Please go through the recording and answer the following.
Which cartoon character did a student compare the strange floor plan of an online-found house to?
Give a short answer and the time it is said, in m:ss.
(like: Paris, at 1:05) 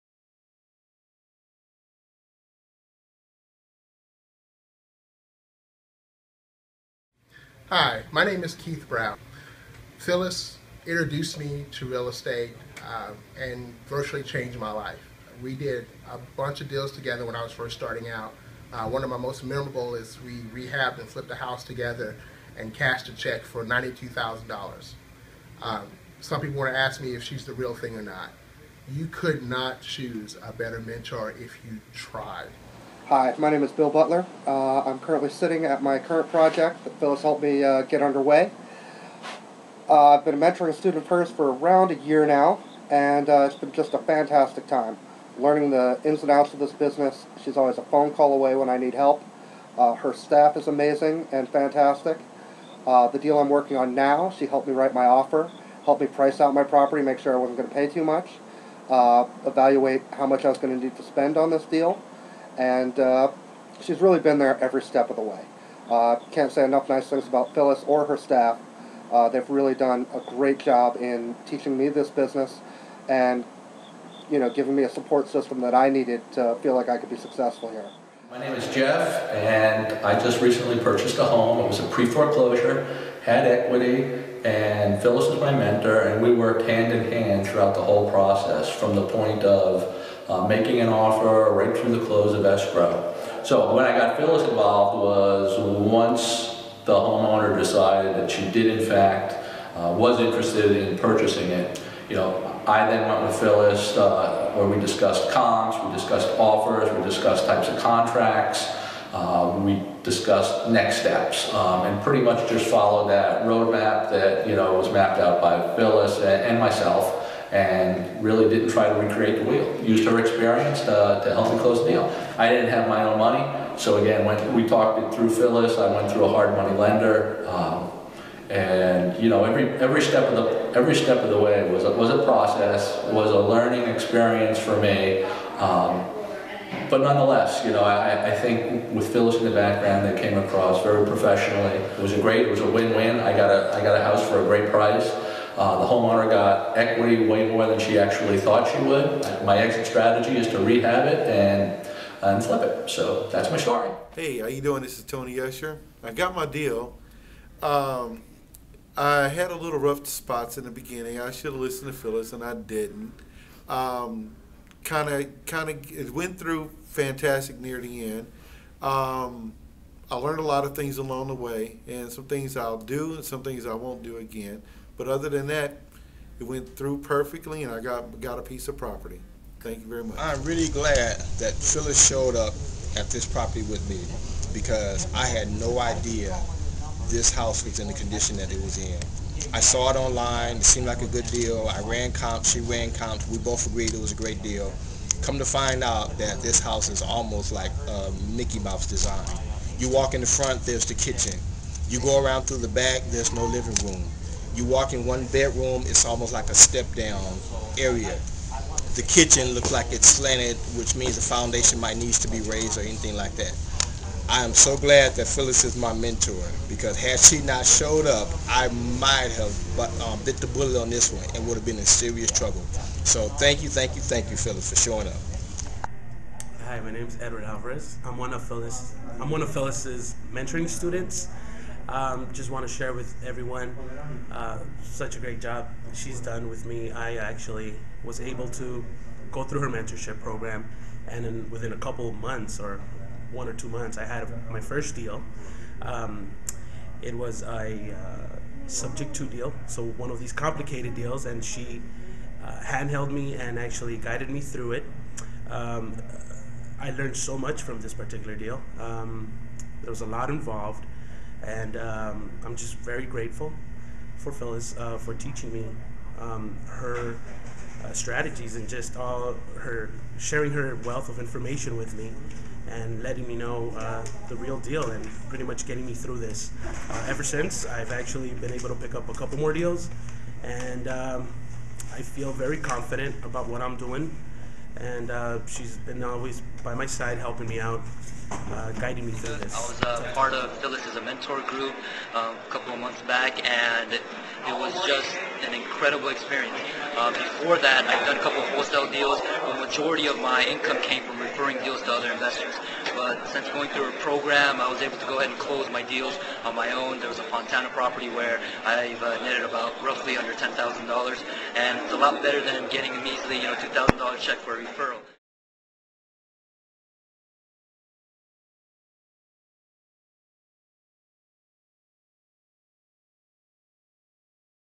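Mickey Mouse, at 3:18.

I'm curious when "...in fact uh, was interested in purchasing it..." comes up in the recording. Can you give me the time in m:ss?
1:38.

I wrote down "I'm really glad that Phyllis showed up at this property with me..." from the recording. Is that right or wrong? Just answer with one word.
right.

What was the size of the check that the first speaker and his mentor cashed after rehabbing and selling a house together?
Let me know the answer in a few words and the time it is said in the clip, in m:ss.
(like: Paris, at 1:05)
$92,000, at 0:23.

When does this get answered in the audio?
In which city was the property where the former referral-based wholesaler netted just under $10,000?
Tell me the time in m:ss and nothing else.
5:07.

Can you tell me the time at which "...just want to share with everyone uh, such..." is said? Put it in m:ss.
3:52.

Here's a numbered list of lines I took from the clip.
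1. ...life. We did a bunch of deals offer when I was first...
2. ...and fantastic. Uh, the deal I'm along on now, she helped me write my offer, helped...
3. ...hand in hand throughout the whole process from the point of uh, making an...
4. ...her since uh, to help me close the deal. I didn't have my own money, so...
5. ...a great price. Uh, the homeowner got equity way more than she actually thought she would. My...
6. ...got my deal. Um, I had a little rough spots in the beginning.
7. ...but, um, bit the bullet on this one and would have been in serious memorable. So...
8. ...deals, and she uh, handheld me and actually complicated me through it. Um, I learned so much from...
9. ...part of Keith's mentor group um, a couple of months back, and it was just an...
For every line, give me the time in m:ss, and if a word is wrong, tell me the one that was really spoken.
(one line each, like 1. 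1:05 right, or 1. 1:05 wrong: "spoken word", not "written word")
1. 0:14 wrong: "together", not "offer"
2. 0:51 wrong: "working", not "along"
3. 1:26 right
4. 2:00 wrong: "experience", not "since"
5. 2:24 right
6. 2:36 right
7. 3:39 wrong: "trouble", not "memorable"
8. 4:10 wrong: "guided", not "complicated"
9. 4:50 wrong: "Phyllis", not "Keith".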